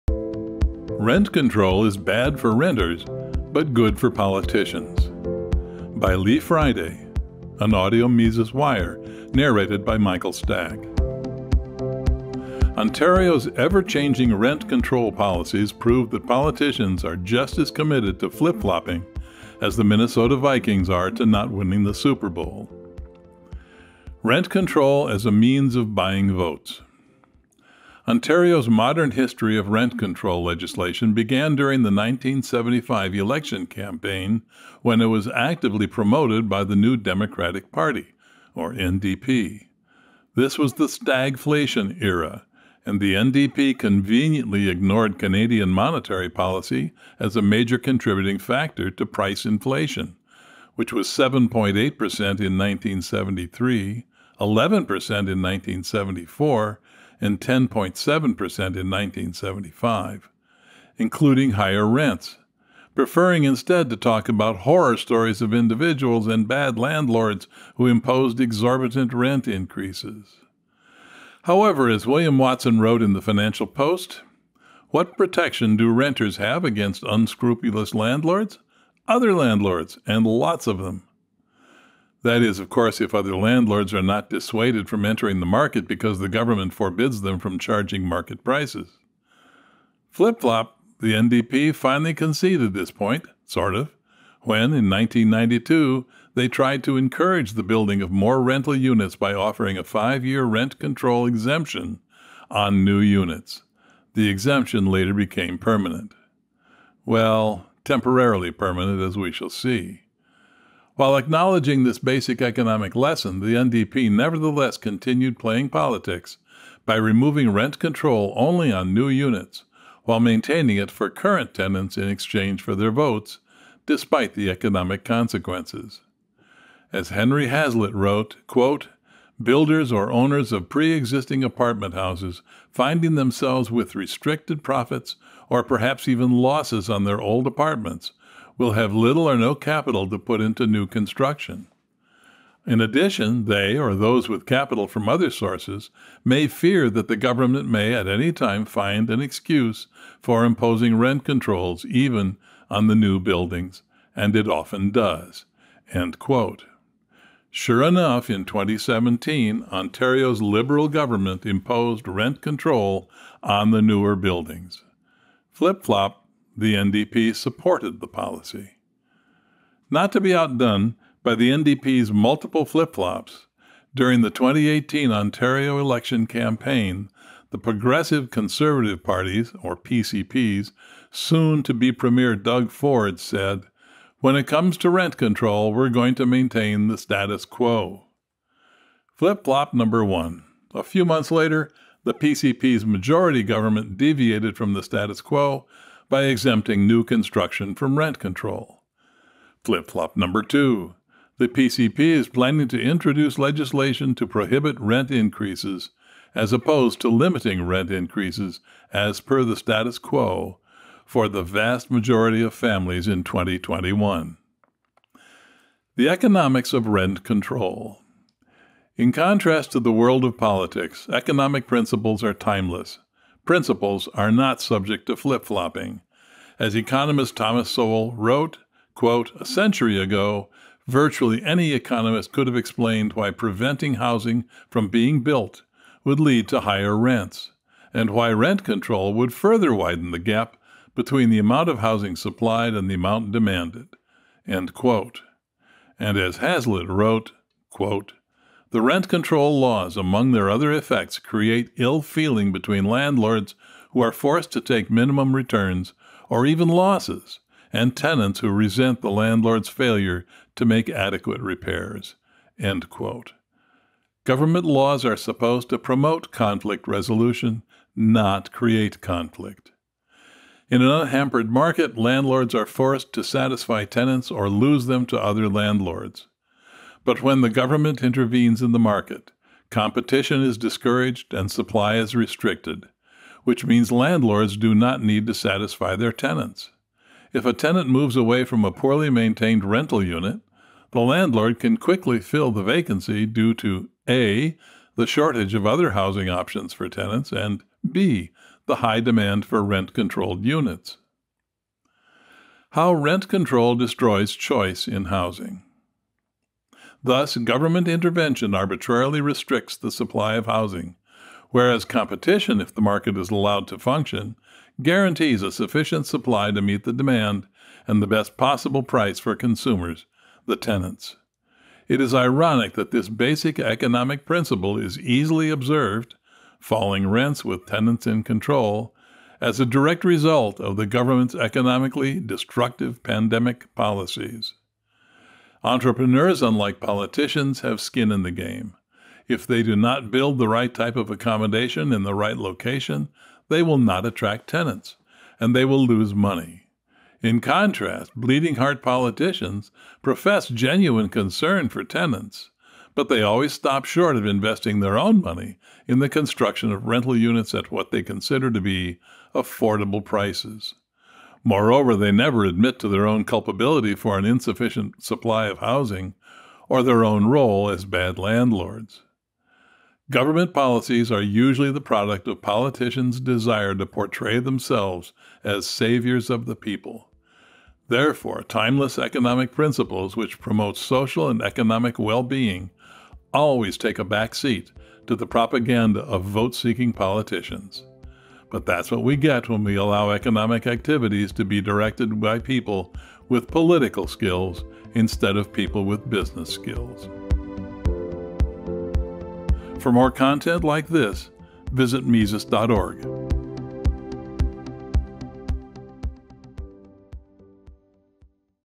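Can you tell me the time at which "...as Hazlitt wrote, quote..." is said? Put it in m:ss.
4:06.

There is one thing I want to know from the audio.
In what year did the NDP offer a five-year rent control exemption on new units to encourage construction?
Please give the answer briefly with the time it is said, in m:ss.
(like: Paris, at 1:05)
1992, at 1:34.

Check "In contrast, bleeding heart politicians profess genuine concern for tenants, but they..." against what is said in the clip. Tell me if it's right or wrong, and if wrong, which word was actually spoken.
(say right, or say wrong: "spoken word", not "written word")
right.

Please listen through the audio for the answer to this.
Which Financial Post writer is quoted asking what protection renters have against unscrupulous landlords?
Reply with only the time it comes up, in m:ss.
1:12.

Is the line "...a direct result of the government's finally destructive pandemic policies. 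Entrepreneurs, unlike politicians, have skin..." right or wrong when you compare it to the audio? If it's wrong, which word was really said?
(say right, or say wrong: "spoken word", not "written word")
wrong: "economically", not "finally".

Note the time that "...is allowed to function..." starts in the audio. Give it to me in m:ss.
5:13.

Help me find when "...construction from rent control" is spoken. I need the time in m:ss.
3:17.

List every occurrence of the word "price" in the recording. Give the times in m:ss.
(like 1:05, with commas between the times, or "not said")
0:49, 1:28, 5:18, 6:00.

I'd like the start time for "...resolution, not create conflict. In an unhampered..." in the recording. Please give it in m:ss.
4:26.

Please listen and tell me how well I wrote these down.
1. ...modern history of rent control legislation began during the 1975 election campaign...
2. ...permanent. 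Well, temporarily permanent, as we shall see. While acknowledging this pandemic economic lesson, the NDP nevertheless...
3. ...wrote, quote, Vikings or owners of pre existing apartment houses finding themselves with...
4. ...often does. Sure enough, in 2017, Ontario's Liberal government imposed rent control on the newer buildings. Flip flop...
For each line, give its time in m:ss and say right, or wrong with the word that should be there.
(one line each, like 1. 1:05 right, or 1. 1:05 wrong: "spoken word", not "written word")
1. 0:28 right
2. 1:45 wrong: "basic", not "pandemic"
3. 2:07 wrong: "Builders", not "Vikings"
4. 2:34 right.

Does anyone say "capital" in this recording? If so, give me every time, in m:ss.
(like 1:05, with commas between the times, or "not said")
2:19, 2:24.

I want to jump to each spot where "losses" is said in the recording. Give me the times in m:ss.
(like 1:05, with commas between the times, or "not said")
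2:16, 4:16.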